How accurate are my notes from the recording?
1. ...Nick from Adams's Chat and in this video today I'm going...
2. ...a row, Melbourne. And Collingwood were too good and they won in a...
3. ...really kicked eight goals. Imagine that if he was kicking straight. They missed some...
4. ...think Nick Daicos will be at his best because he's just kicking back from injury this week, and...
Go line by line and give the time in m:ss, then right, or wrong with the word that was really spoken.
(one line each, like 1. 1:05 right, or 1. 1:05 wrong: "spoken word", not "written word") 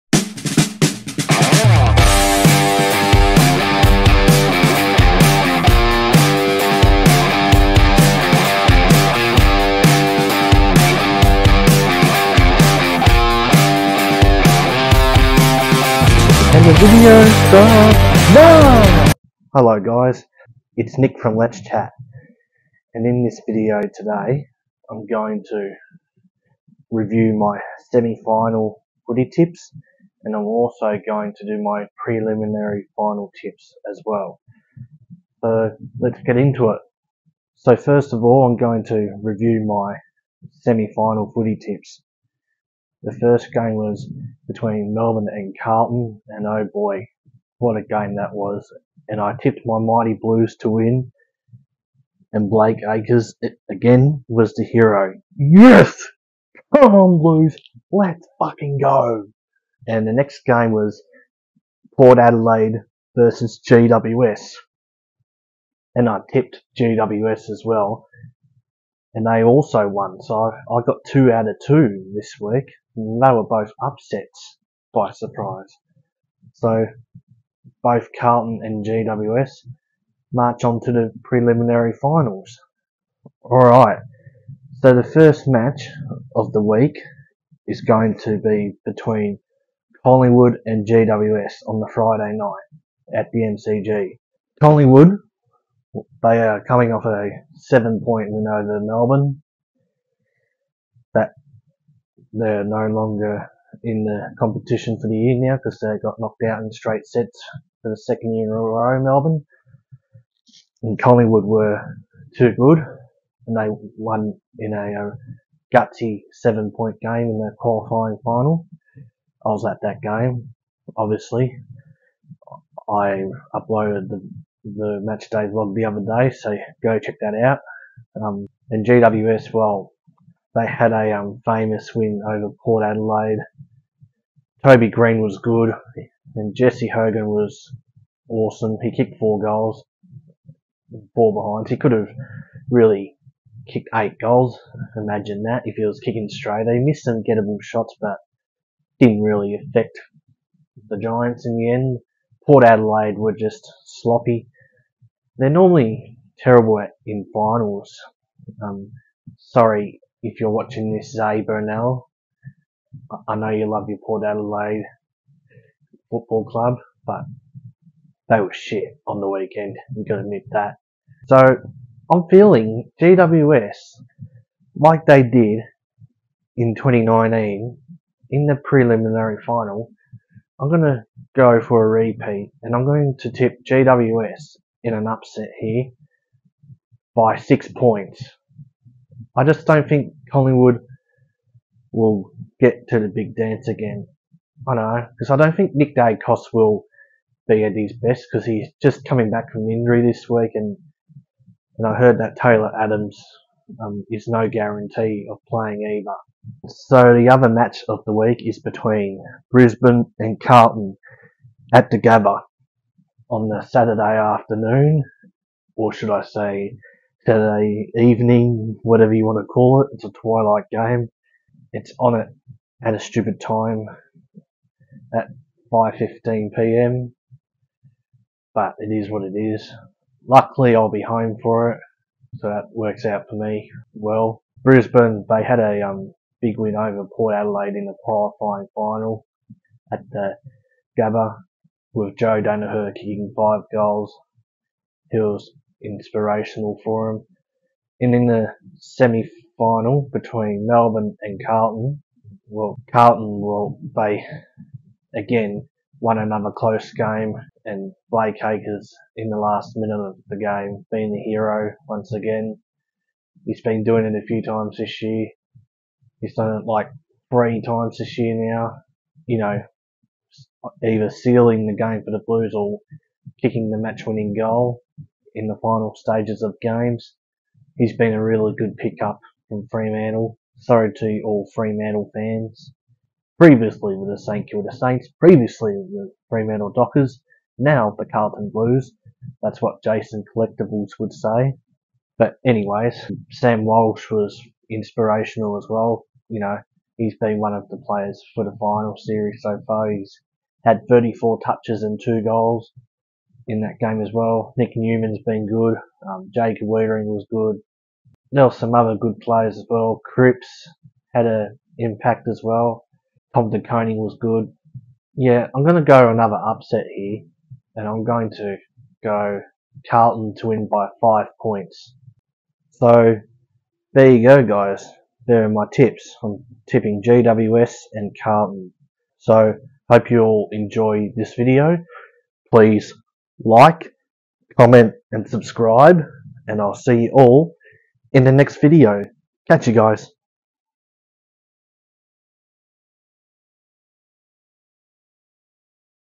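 1. 0:20 wrong: "Let", not "Adams"
2. 1:48 right
3. 2:22 right
4. 3:15 wrong: "coming", not "kicking".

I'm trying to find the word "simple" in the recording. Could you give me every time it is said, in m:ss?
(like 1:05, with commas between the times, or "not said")
not said.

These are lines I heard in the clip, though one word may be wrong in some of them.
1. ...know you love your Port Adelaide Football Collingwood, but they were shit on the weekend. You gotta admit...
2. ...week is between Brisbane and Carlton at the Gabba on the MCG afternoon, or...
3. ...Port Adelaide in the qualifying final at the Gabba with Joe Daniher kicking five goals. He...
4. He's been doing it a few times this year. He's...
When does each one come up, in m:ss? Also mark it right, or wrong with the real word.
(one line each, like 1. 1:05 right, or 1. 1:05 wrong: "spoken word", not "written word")
1. 2:43 wrong: "Club", not "Collingwood"
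2. 3:28 wrong: "Saturday", not "MCG"
3. 3:57 right
4. 4:23 right.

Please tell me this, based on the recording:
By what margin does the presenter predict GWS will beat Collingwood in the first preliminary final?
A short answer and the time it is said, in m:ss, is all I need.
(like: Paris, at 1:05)
6 points, at 3:07.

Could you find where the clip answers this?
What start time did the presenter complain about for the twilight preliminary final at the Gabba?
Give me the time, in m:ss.
3:45.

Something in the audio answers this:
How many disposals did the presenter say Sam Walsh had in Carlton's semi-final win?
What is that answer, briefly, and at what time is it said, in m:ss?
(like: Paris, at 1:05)
34, at 5:00.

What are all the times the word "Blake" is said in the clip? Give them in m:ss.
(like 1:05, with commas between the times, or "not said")
0:52, 4:18.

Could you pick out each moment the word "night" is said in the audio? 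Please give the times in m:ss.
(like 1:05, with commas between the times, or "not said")
1:32.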